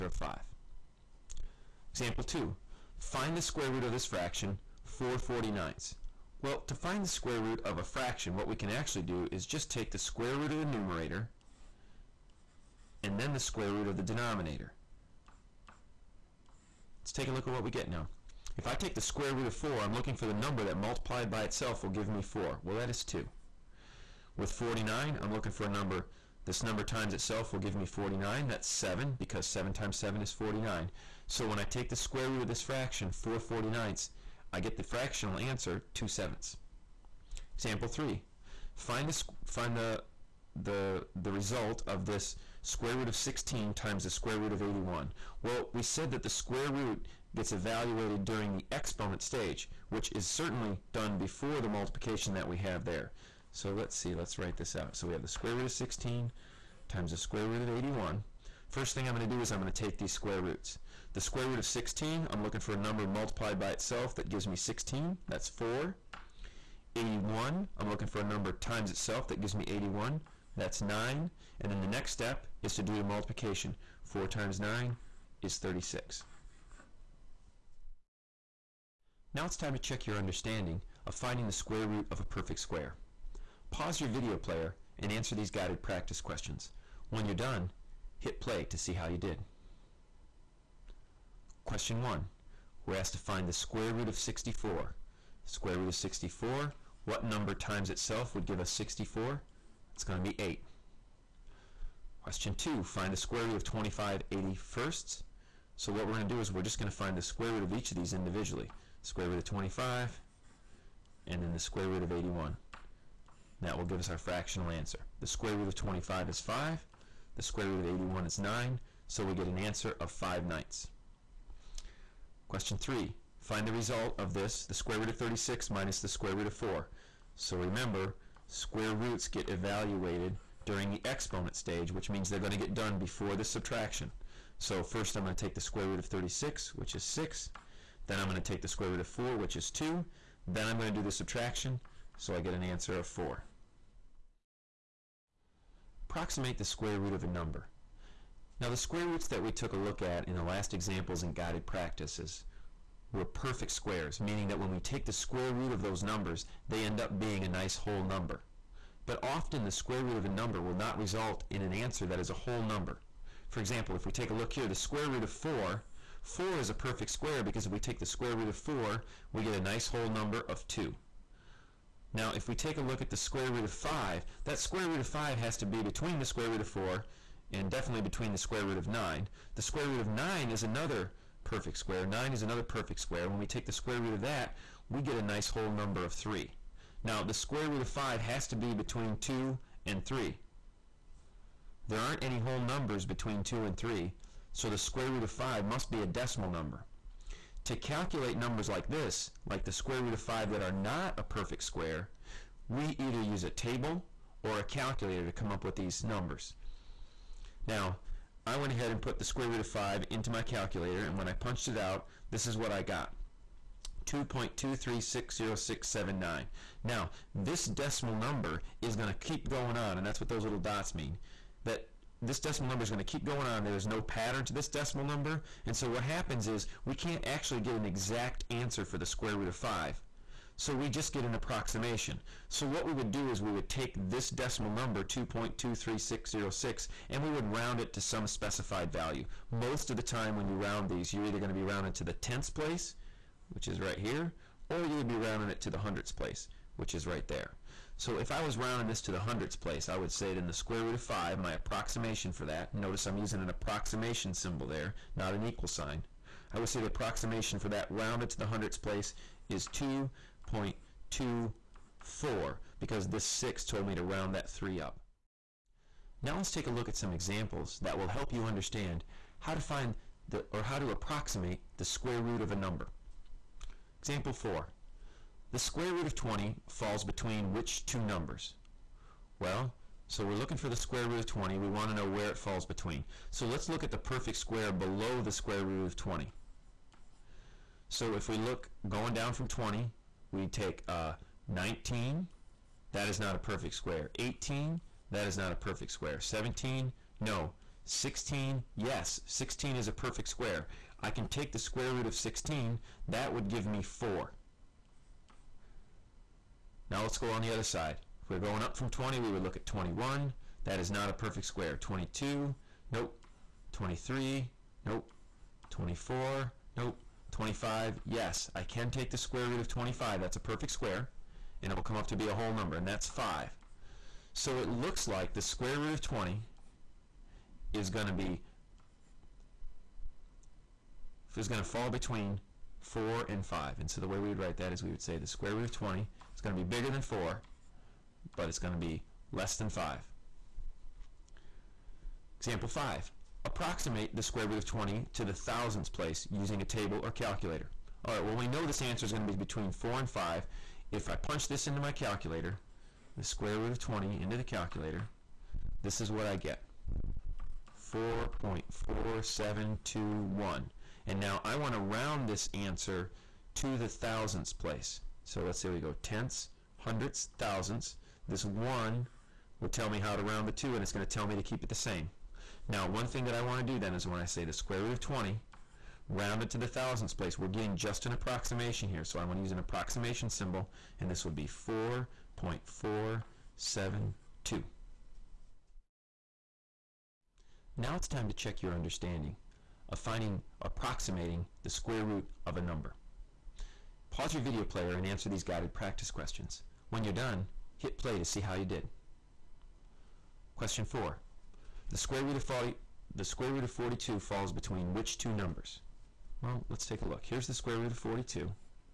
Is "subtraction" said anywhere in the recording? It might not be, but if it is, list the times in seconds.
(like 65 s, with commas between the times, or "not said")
133 s, 141 s.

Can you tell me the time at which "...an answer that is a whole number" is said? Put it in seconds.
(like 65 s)
161 s.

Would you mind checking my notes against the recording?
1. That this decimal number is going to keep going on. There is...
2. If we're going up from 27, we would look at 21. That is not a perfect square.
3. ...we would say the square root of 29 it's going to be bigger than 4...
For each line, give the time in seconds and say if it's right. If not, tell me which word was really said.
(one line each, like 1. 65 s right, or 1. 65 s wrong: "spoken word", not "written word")
1. 221 s right
2. 308 s wrong: "20", not "27"
3. 334 s wrong: "20", not "29".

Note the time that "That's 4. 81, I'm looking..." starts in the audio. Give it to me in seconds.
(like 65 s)
65 s.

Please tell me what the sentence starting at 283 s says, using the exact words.
So let's look at the perfect square below the square root of 20.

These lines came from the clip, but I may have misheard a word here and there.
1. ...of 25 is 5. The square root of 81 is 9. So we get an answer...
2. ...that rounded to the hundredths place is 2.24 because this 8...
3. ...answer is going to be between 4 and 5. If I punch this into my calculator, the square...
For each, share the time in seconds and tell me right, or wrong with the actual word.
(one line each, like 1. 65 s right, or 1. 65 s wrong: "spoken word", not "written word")
1. 115 s right
2. 257 s wrong: "6", not "8"
3. 348 s right.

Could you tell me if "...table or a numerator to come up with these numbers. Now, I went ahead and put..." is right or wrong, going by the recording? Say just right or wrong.
wrong.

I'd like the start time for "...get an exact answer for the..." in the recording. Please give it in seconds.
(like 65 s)
227 s.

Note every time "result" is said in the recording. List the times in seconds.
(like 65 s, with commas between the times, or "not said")
41 s, 123 s, 160 s.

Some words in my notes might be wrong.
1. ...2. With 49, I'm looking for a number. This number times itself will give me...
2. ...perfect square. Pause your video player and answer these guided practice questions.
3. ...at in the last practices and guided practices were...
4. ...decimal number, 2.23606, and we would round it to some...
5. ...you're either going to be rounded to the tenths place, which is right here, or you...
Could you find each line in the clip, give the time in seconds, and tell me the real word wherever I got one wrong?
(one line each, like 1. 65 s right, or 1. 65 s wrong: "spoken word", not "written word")
1. 23 s right
2. 82 s right
3. 150 s wrong: "examples", not "practices"
4. 234 s right
5. 241 s right.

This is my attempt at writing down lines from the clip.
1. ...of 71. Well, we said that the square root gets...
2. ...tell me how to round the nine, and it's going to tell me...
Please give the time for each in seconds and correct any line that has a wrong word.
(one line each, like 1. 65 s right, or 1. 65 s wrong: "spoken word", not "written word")
1. 44 s wrong: "81", not "71"
2. 369 s wrong: "two", not "nine".